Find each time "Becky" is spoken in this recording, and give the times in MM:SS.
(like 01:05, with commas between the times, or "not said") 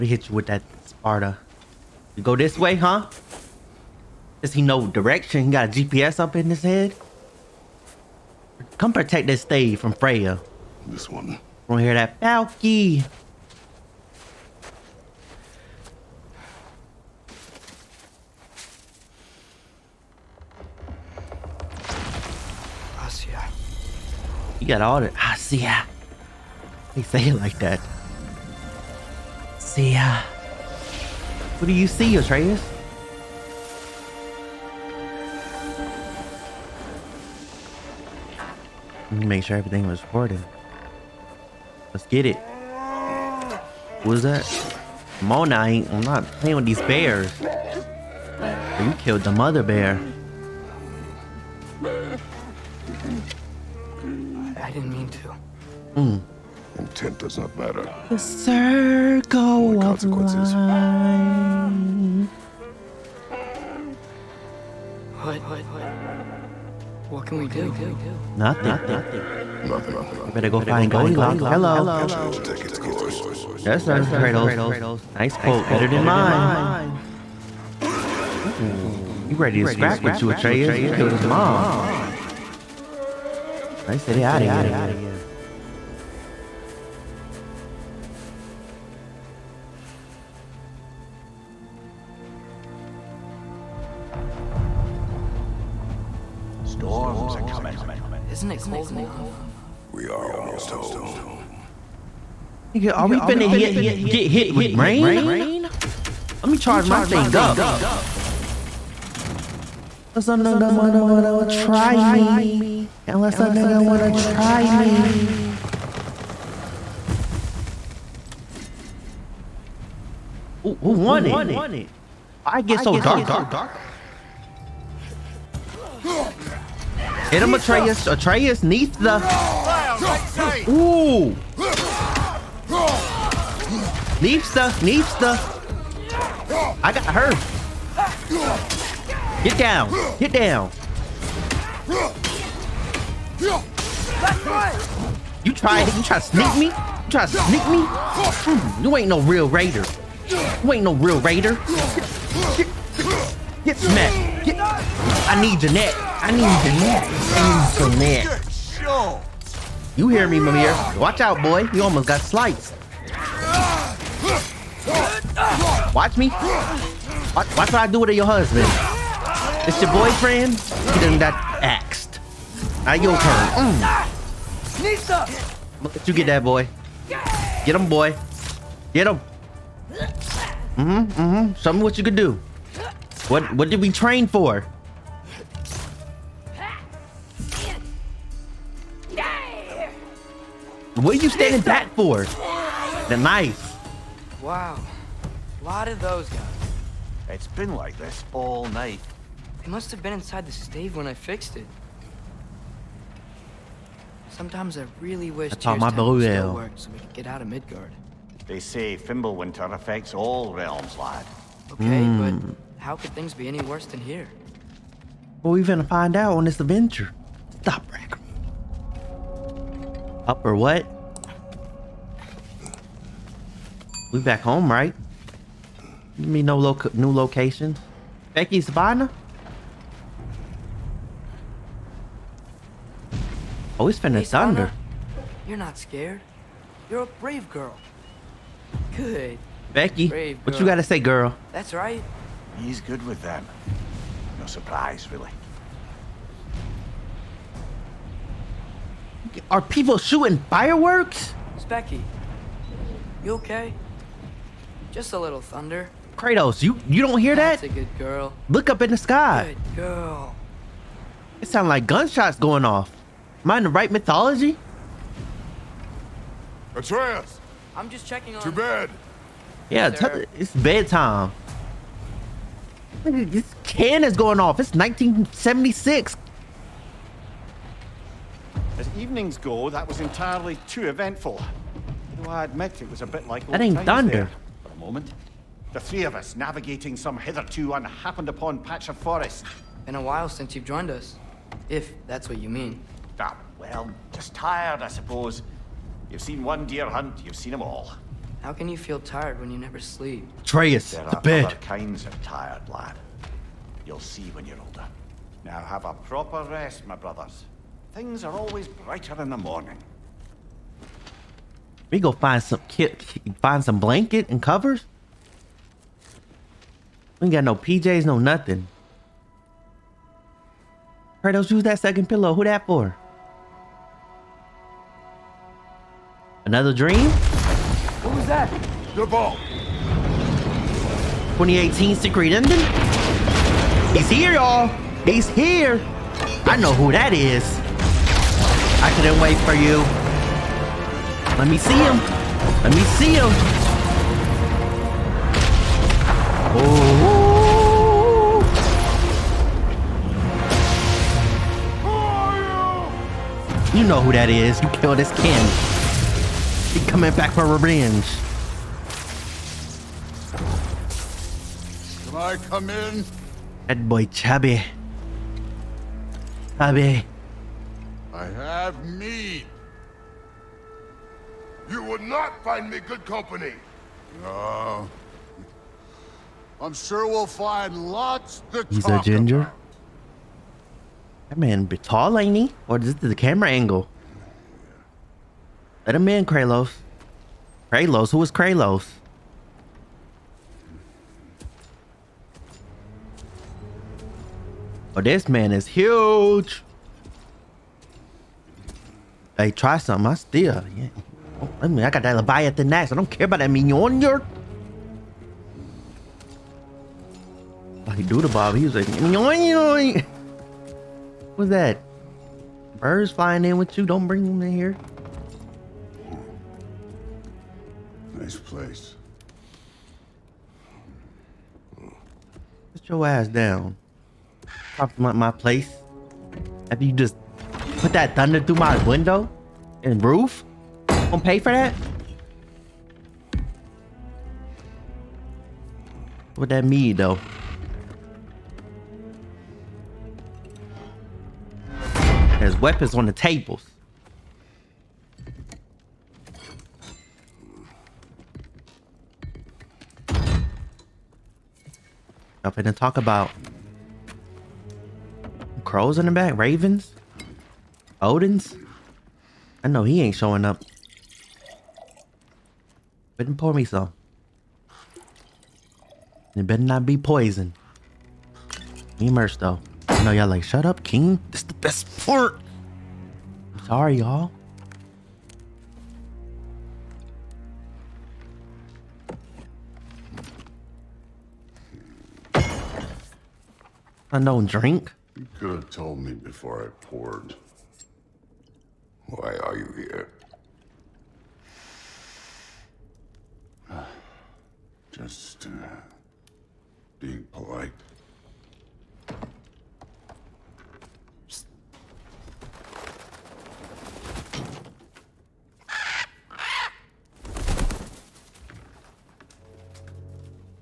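03:48, 03:59, 04:11.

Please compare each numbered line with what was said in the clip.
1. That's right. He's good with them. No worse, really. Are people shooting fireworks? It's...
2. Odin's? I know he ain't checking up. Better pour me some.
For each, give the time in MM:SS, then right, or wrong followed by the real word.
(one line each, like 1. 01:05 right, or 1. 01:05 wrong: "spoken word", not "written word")
1. 04:01 wrong: "surprise", not "worse"
2. 07:38 wrong: "showing", not "checking".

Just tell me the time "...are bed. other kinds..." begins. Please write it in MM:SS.
05:01.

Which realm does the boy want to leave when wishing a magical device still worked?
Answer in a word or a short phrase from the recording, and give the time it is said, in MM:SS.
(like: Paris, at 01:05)
Midgard, at 03:27.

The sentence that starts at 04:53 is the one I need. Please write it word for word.
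Ah, well, just tired, I suppose.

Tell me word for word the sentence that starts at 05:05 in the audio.
Now have a proper rest, my brothers.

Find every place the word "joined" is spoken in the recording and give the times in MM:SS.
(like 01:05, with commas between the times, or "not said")
04:50.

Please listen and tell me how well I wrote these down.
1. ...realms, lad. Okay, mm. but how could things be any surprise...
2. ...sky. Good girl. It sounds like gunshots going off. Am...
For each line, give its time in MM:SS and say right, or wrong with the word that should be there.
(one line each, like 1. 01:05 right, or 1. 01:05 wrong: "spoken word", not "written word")
1. 03:30 wrong: "worse", not "surprise"
2. 04:18 right.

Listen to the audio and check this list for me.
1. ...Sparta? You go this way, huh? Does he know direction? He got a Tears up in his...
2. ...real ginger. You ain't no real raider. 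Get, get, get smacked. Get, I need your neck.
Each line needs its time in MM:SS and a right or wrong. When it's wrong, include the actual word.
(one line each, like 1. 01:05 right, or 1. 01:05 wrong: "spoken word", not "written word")
1. 00:00 wrong: "GPS", not "Tears"
2. 02:29 wrong: "raider", not "ginger".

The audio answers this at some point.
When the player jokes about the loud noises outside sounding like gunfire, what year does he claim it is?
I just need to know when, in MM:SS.
04:34.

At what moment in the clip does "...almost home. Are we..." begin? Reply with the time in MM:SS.
01:40.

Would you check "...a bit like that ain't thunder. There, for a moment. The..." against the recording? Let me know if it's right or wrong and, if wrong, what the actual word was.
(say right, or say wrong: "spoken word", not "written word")
right.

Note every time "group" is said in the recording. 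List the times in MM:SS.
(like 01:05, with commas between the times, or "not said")
not said.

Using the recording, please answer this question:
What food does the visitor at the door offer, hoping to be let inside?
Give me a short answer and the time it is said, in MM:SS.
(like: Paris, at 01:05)
Meat, at 06:08.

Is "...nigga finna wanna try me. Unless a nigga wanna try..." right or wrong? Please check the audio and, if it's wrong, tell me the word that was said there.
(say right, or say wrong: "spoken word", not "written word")
wrong: "wanna", not "finna".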